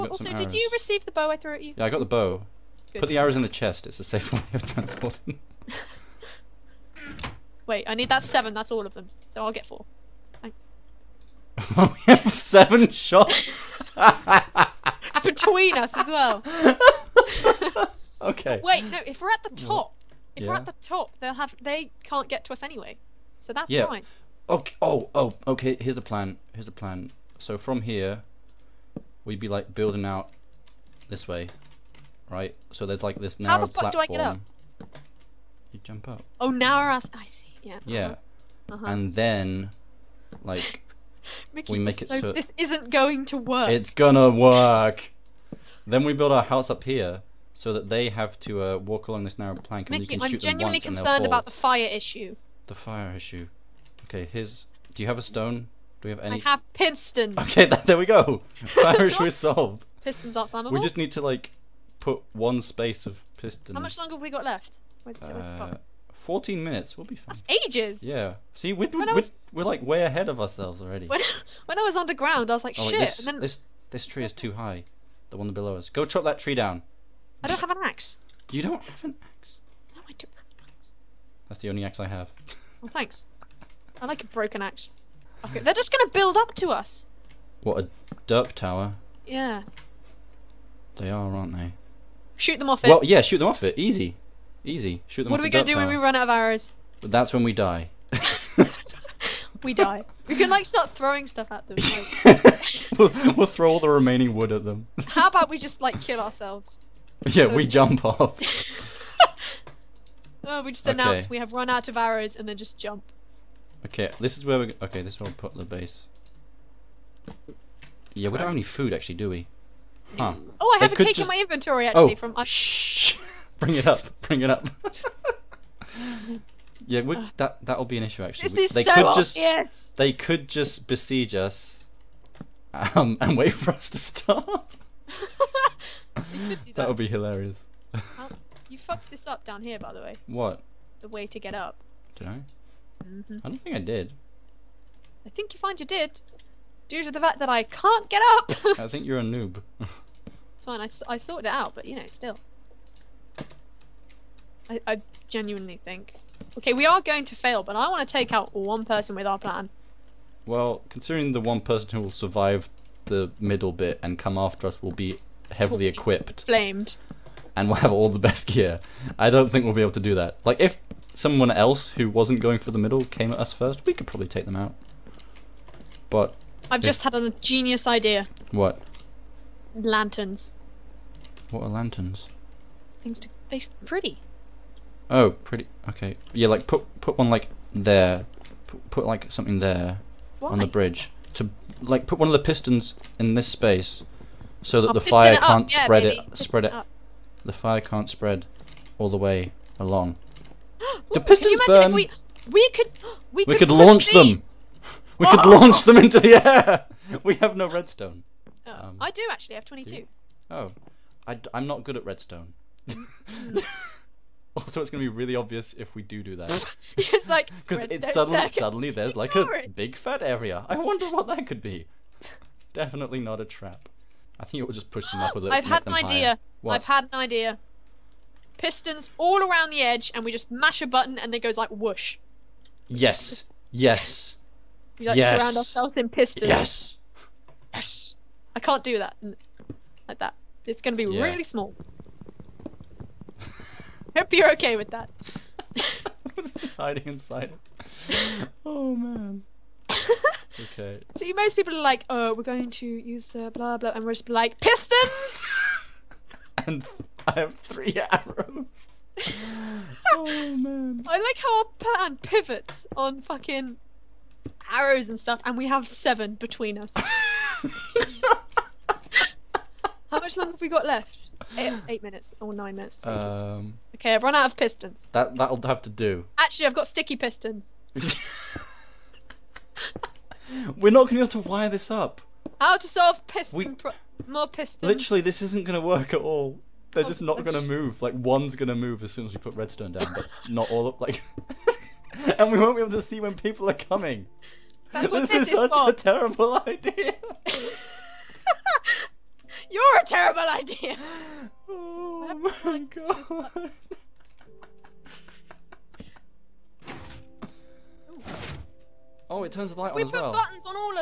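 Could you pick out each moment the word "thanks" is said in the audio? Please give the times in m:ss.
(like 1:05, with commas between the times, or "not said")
0:10, 1:22.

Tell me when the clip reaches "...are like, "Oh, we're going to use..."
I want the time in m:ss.
4:11.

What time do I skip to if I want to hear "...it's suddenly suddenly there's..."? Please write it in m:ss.
3:37.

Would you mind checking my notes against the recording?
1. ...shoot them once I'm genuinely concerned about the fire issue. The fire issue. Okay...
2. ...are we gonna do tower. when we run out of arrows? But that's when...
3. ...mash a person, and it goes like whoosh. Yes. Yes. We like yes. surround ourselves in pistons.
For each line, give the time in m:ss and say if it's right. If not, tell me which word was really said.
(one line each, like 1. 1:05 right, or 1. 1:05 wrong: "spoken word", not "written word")
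1. 0:50 right
2. 1:35 right
3. 3:50 wrong: "button", not "person".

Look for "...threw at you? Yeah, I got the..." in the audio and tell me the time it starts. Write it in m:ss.
0:01.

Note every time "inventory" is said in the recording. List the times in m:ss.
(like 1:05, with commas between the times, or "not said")
2:01.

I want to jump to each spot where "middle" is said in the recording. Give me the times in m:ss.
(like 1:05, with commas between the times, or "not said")
2:43, 2:52.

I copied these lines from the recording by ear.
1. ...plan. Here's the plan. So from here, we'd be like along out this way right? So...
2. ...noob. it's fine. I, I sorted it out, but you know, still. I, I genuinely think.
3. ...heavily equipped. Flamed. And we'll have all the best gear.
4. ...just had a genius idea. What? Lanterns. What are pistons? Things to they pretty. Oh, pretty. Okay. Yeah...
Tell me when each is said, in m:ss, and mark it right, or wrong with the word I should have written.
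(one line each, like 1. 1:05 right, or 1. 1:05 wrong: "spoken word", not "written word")
1. 0:26 wrong: "building", not "along"
2. 2:29 right
3. 2:45 right
4. 2:56 wrong: "lanterns", not "pistons".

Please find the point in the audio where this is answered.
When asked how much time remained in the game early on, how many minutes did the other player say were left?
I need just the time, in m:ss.
1:06.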